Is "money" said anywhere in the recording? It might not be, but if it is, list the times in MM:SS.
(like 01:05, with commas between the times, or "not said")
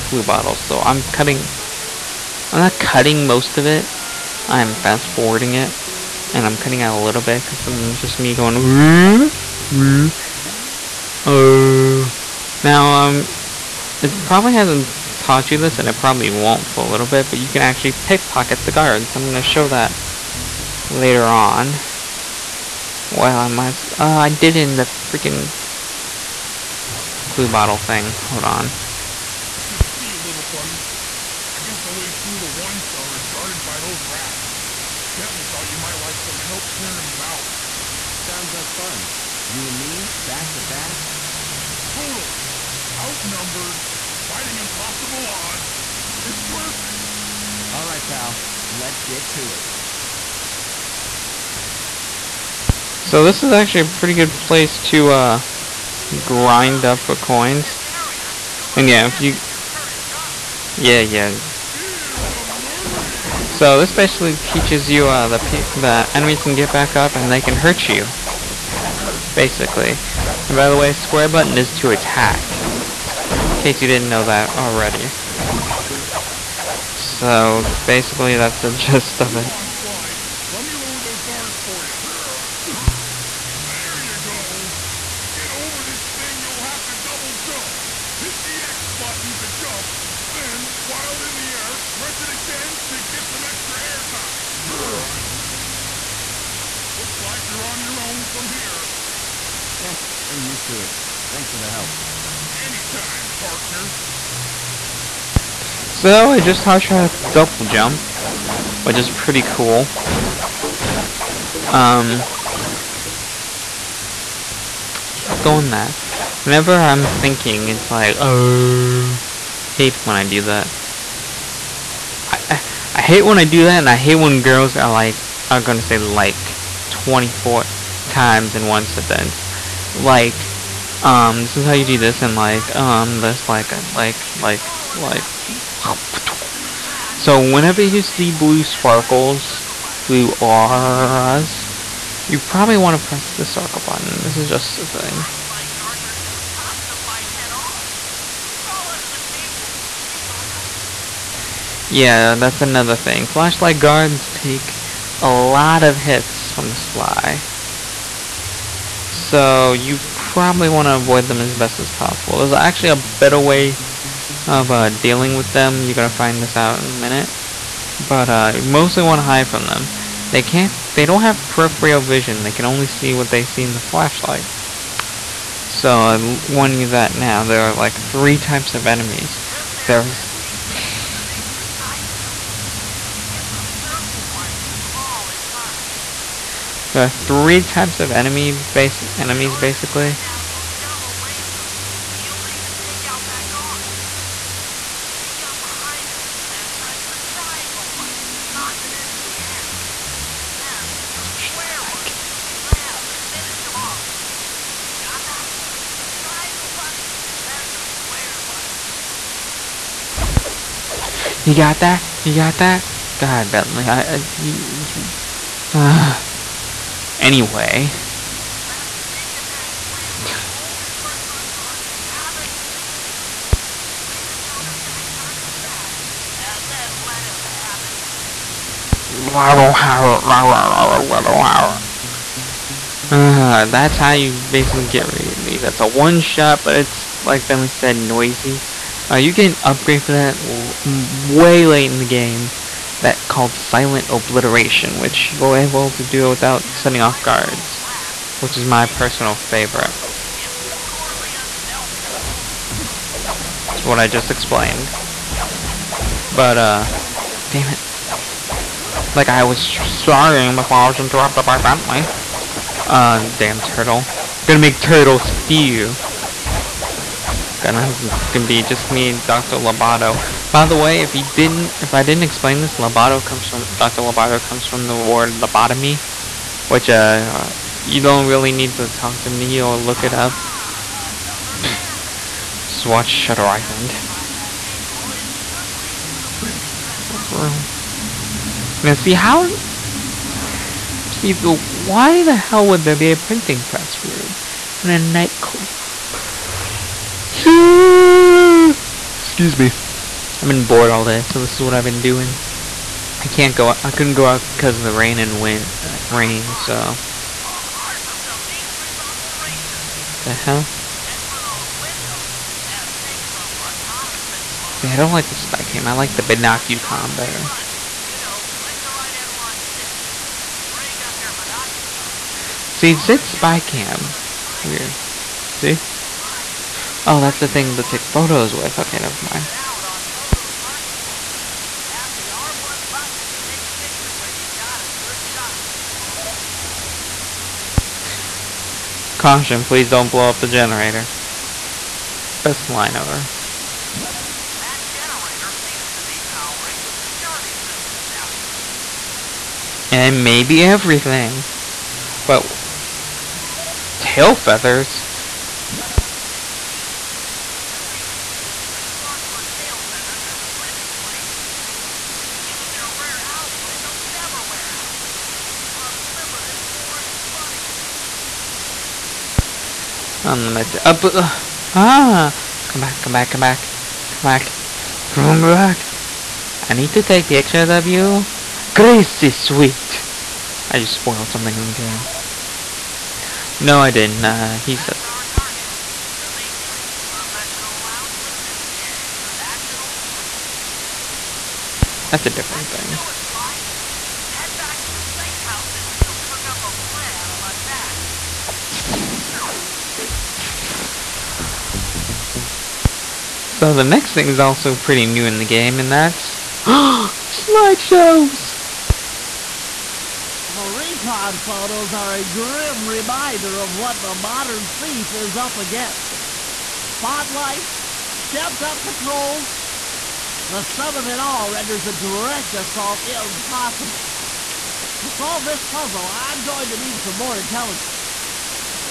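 06:07.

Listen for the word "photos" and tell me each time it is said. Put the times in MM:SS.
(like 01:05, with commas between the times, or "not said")
05:14, 05:28, 06:51.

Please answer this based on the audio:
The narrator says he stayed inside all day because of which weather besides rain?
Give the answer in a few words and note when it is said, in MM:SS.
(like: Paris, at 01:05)
Wind, at 05:05.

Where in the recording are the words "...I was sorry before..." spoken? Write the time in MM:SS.
04:19.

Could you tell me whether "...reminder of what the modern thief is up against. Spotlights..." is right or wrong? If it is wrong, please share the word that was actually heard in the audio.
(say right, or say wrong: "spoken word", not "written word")
right.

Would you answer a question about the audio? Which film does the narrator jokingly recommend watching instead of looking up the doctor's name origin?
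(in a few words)
Shutter Island.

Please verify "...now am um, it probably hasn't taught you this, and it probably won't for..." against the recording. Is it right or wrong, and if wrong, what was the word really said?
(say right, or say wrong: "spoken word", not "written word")
right.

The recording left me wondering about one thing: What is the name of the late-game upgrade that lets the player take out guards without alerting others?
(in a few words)
Silent Obliteration.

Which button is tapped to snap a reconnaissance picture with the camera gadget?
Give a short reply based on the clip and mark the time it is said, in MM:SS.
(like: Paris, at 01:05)
R1, at 05:32.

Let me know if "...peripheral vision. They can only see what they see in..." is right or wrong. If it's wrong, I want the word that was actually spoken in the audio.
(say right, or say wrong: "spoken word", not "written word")
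right.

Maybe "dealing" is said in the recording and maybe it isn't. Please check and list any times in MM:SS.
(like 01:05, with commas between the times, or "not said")
02:44.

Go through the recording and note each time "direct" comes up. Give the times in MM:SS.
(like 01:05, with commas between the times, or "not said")
07:01.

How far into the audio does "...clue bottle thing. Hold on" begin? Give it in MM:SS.
00:27.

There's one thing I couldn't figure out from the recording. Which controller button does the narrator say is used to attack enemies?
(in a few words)
Square.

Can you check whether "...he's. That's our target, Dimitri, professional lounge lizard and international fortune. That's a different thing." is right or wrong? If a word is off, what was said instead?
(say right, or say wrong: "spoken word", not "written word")
right.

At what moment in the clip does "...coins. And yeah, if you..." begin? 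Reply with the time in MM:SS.
00:57.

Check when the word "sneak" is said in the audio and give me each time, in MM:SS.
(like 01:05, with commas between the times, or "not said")
02:29, 03:39.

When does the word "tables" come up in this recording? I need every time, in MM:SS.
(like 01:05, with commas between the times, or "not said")
02:29.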